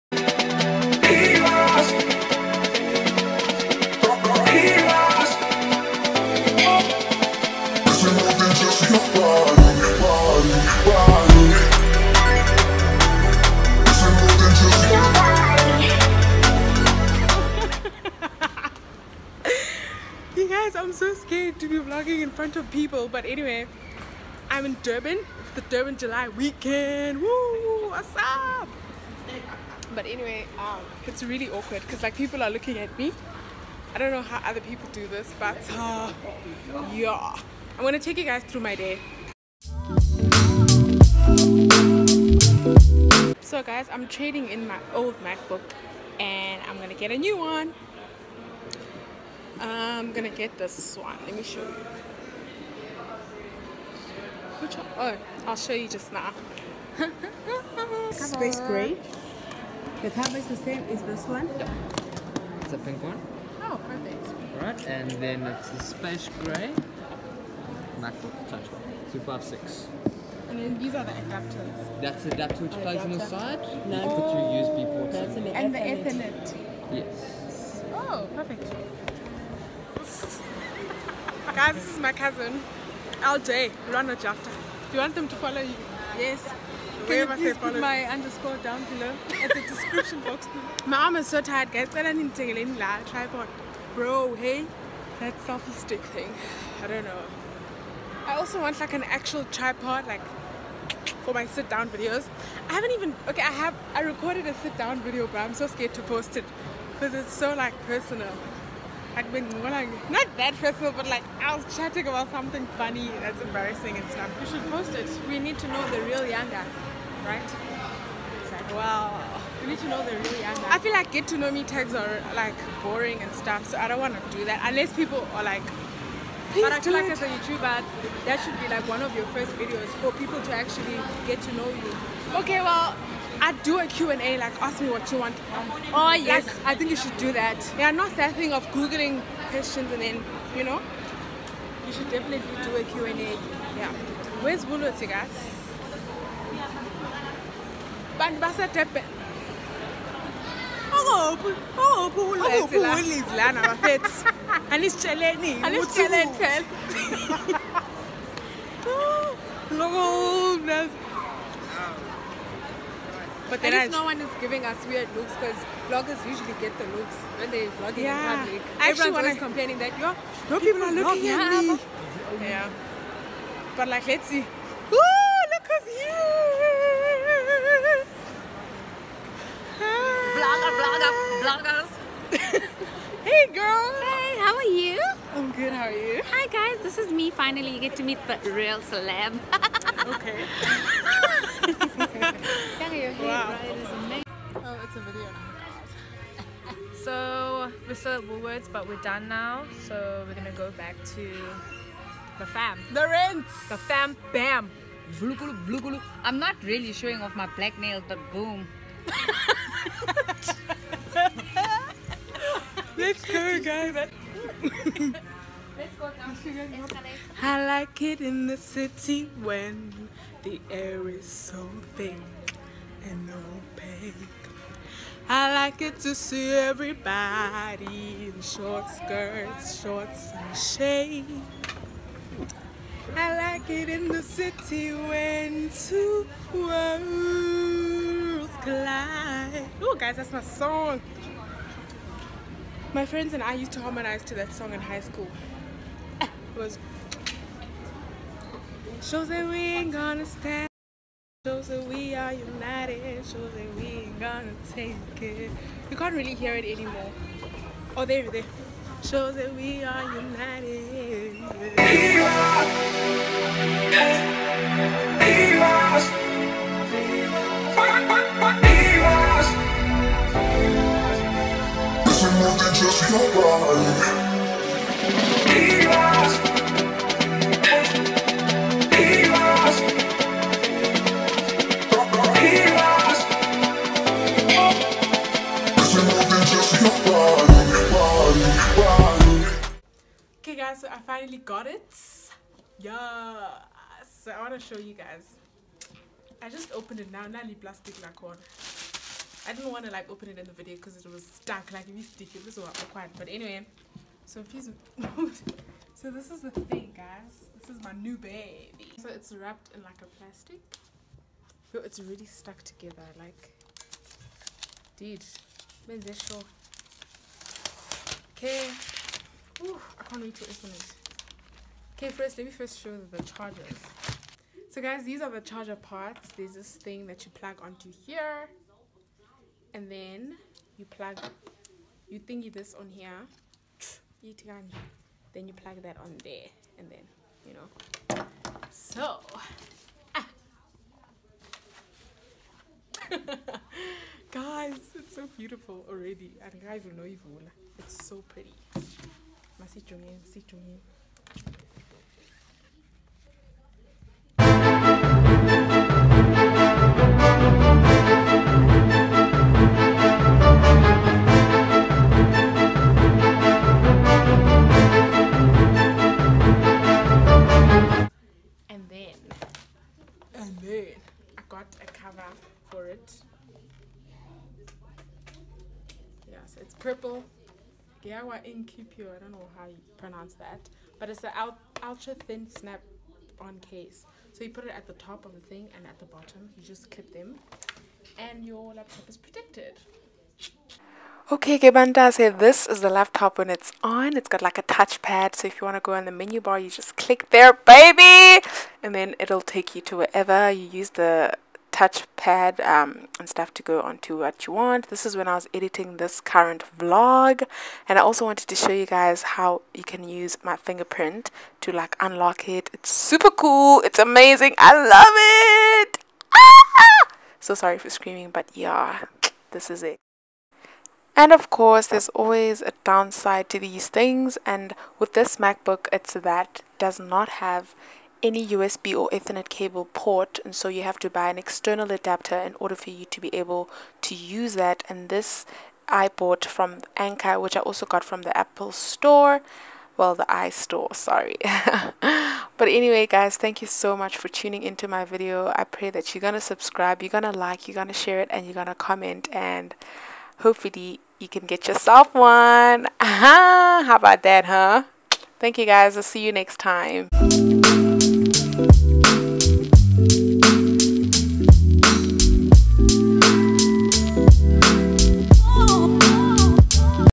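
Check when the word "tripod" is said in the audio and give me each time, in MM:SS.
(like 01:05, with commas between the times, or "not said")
01:33, 01:39.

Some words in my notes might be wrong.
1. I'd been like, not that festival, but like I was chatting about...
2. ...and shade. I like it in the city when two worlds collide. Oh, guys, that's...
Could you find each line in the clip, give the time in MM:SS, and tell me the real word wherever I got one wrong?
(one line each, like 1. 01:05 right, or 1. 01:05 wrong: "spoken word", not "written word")
1. 01:49 right
2. 03:50 right.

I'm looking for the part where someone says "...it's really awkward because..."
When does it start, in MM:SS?
00:31.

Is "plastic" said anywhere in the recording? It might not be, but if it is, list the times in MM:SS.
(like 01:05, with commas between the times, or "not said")
04:57, 05:10.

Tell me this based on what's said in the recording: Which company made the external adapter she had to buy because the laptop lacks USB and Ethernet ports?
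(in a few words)
Anker.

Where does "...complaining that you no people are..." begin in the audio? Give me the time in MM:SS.
02:49.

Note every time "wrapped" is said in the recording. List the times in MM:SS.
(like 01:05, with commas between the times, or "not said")
05:09.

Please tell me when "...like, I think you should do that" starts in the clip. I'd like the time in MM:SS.
02:16.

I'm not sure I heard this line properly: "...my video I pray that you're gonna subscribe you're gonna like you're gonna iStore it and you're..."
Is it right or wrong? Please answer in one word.
wrong.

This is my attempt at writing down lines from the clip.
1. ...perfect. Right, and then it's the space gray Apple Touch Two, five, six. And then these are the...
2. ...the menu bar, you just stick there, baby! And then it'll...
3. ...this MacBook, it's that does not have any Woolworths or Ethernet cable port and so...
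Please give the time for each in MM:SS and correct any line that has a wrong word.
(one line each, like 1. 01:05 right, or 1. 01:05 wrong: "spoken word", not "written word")
1. 01:03 wrong: "MacBook", not "Apple"
2. 06:36 wrong: "click", not "stick"
3. 07:05 wrong: "USB", not "Woolworths".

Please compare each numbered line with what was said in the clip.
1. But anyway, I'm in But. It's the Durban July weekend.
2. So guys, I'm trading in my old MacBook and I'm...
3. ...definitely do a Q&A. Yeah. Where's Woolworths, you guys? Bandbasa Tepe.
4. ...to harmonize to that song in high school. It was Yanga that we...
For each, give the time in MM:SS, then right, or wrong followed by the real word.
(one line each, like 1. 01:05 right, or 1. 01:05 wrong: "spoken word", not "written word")
1. 00:23 wrong: "Durban", not "But"
2. 00:43 right
3. 02:22 right
4. 04:03 wrong: "Shows", not "Yanga".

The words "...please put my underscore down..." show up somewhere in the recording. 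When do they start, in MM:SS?
01:27.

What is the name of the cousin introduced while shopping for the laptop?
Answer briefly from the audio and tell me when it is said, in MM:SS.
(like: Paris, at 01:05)
LJ, at 01:23.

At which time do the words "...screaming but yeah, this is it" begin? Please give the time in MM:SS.
06:57.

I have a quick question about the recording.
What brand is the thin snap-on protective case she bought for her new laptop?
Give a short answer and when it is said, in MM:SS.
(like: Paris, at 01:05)
Incipio, at 06:18.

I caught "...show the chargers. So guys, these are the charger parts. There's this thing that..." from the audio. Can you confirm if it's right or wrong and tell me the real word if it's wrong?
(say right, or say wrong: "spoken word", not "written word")
right.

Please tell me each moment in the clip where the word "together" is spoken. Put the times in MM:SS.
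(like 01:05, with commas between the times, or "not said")
05:12.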